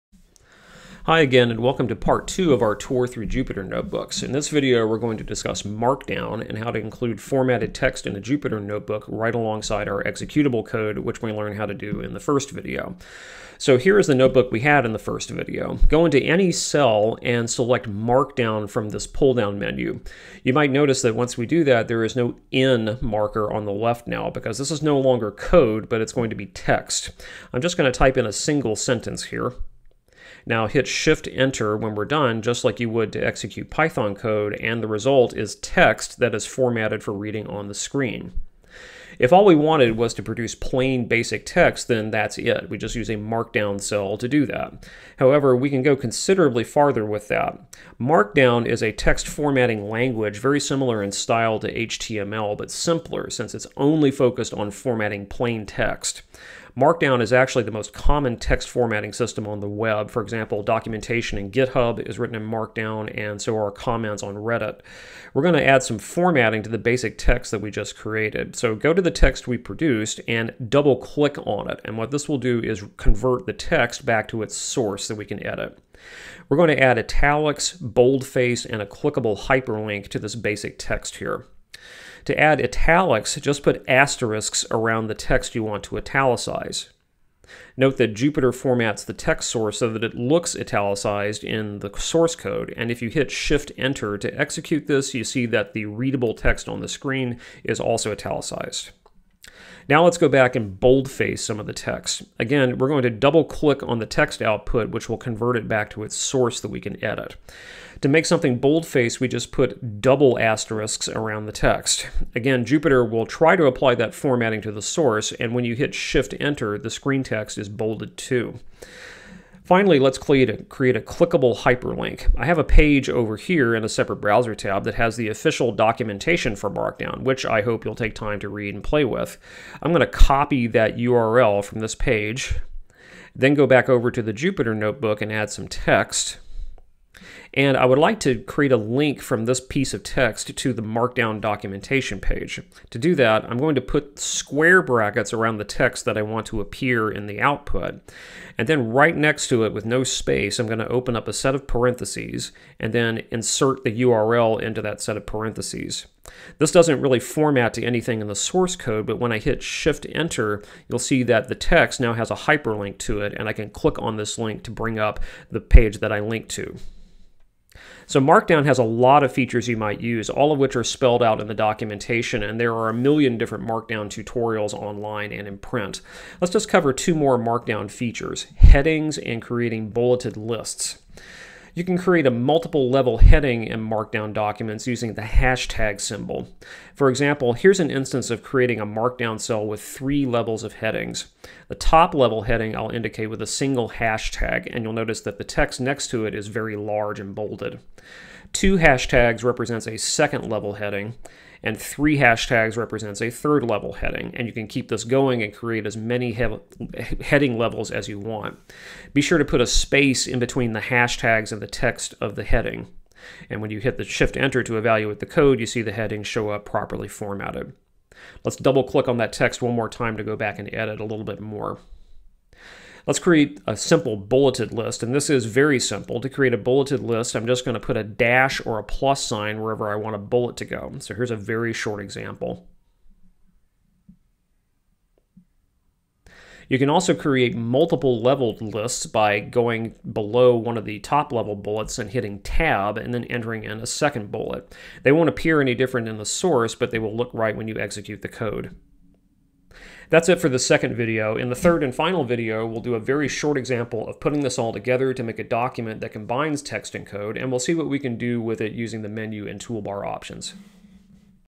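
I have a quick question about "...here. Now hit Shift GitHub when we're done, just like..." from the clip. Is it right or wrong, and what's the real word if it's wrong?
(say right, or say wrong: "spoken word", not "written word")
wrong: "Enter", not "GitHub".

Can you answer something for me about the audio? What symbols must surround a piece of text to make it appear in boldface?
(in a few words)
Double asterisks.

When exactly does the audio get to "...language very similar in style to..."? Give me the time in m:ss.
0:49.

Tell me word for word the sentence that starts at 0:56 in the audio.
Markdown is actually the most common text formatting system on the web.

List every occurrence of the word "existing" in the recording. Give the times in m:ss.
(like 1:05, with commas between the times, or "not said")
not said.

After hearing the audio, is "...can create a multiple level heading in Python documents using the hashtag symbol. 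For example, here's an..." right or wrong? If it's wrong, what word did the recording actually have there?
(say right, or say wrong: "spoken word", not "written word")
wrong: "Markdown", not "Python".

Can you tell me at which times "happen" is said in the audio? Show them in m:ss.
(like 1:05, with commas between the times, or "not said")
not said.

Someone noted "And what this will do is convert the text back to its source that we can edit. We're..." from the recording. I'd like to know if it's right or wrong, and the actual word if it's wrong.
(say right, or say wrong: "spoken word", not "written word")
right.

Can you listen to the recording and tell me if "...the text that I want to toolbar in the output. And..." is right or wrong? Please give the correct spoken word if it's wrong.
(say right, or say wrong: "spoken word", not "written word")
wrong: "appear", not "toolbar".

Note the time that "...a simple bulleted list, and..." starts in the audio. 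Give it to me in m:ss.
3:43.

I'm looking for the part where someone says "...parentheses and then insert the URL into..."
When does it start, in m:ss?
2:31.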